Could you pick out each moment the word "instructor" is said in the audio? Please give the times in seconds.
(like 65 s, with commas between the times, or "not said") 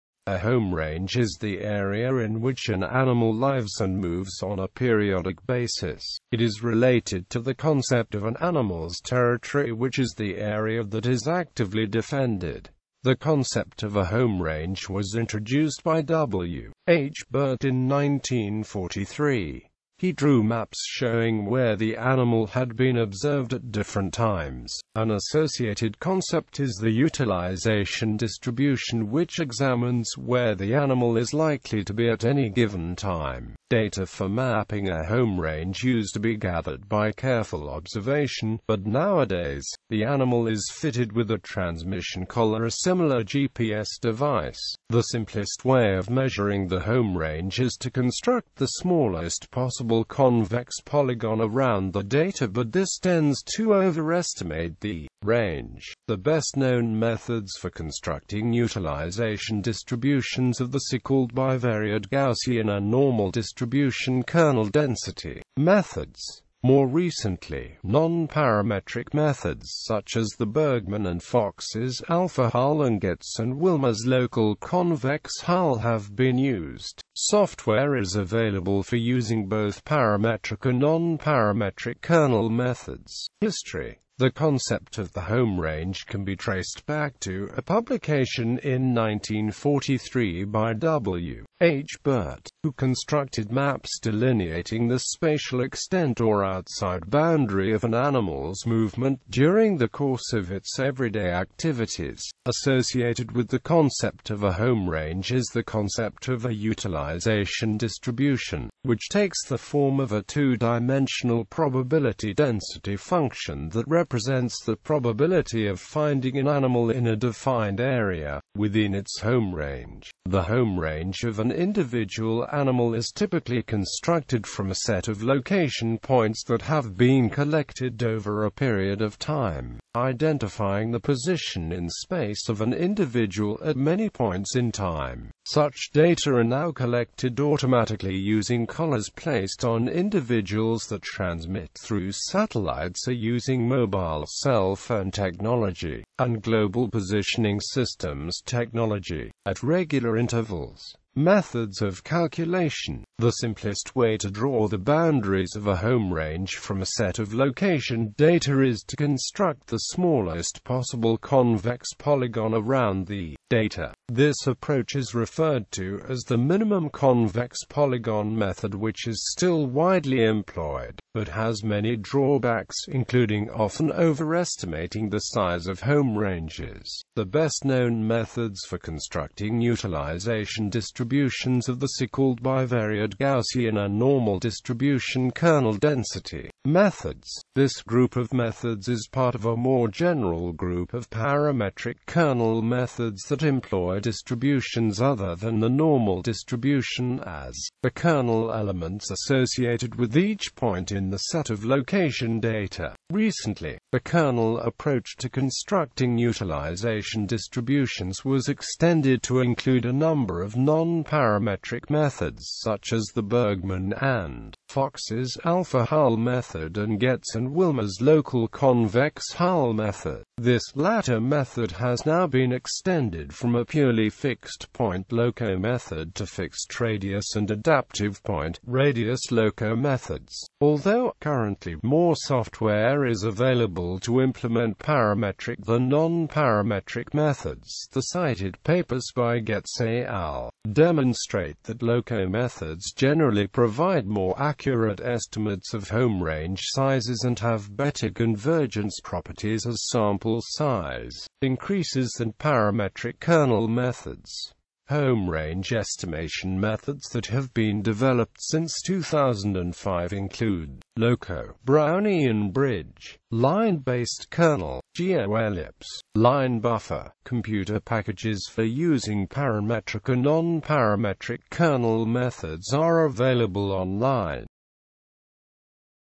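not said.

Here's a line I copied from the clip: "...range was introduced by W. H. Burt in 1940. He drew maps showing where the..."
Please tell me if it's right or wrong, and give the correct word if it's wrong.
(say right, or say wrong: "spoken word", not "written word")
wrong: "1943", not "1940".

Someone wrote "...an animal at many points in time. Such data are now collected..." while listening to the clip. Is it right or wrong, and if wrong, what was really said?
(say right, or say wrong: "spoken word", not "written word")
wrong: "individual", not "animal".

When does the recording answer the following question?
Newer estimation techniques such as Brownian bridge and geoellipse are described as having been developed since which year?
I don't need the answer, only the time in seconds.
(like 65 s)
258 s.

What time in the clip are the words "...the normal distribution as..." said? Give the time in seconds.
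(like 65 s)
195 s.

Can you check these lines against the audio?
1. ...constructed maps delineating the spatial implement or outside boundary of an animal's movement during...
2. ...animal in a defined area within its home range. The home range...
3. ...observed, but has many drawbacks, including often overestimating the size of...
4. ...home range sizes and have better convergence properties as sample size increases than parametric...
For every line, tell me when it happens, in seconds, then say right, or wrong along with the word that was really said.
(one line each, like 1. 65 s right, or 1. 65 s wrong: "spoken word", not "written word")
1. 92 s wrong: "extent", not "implement"
2. 116 s right
3. 170 s wrong: "employed", not "observed"
4. 245 s right.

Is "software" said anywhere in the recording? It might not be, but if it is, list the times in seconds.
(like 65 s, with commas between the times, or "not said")
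77 s, 232 s.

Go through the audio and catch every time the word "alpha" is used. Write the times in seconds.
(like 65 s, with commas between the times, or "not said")
72 s, 215 s.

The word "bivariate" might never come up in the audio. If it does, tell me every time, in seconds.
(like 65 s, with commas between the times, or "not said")
61 s, 182 s.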